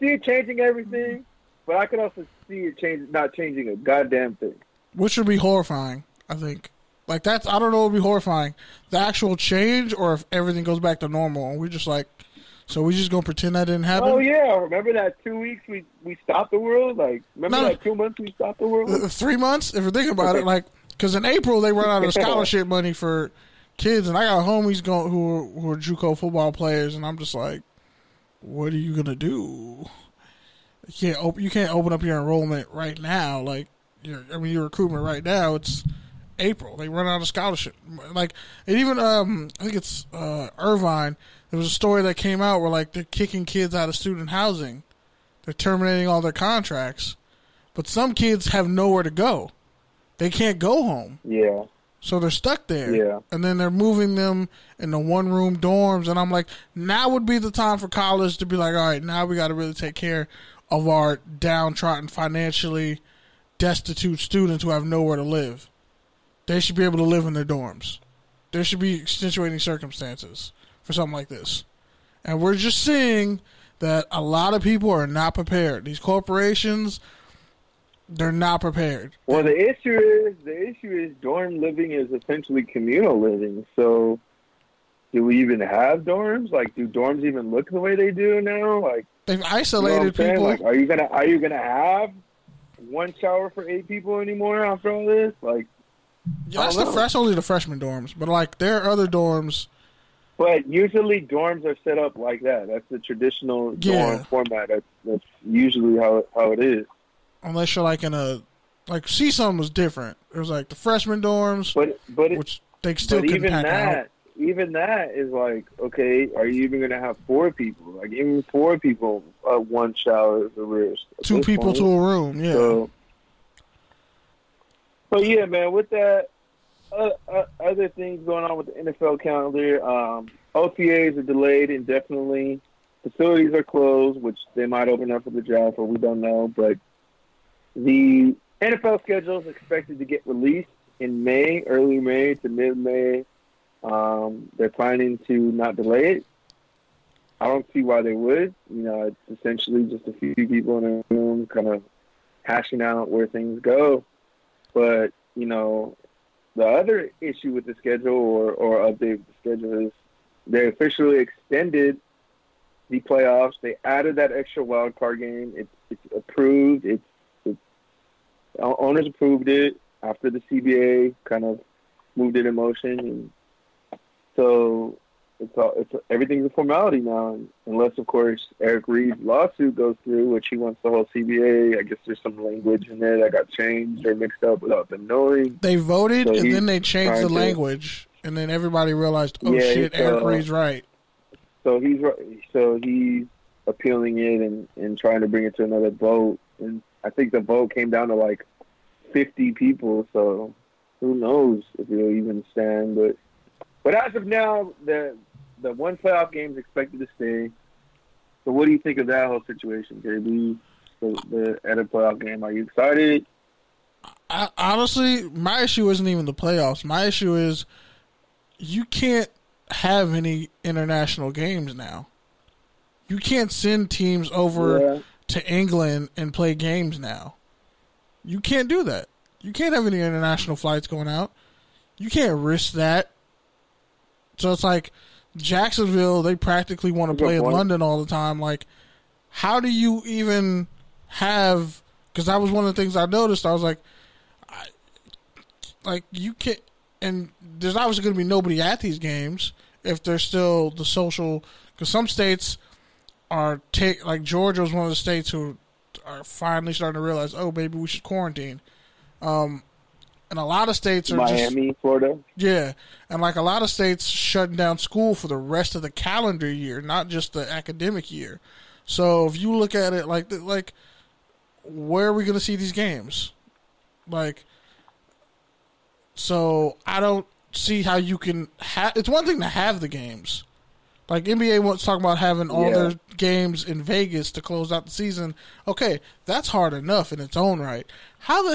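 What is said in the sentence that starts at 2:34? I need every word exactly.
But you know, the other issue with the schedule or or update the schedule is they officially extended the playoffs.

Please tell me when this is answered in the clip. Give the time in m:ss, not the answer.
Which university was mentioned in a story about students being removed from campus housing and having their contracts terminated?
0:40.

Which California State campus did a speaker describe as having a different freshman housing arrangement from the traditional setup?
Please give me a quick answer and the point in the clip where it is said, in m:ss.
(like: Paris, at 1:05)
CSUN, at 1:49.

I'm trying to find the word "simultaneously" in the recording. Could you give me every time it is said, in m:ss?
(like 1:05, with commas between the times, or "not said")
not said.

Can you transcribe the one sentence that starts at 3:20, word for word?
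So who knows if it'll even stand, but.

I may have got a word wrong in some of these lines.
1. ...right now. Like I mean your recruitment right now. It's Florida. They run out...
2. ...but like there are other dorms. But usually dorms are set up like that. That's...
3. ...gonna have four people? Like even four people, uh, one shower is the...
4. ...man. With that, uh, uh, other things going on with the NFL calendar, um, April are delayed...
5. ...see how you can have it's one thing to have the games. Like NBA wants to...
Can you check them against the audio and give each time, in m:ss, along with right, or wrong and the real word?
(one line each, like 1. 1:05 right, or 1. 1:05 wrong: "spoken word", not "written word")
1. 0:32 wrong: "April", not "Florida"
2. 1:38 right
3. 1:56 right
4. 2:05 wrong: "OTAs", not "April"
5. 4:37 right.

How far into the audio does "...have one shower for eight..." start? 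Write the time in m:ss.
1:31.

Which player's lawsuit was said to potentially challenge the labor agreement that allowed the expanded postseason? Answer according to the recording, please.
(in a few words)
Eric Reid.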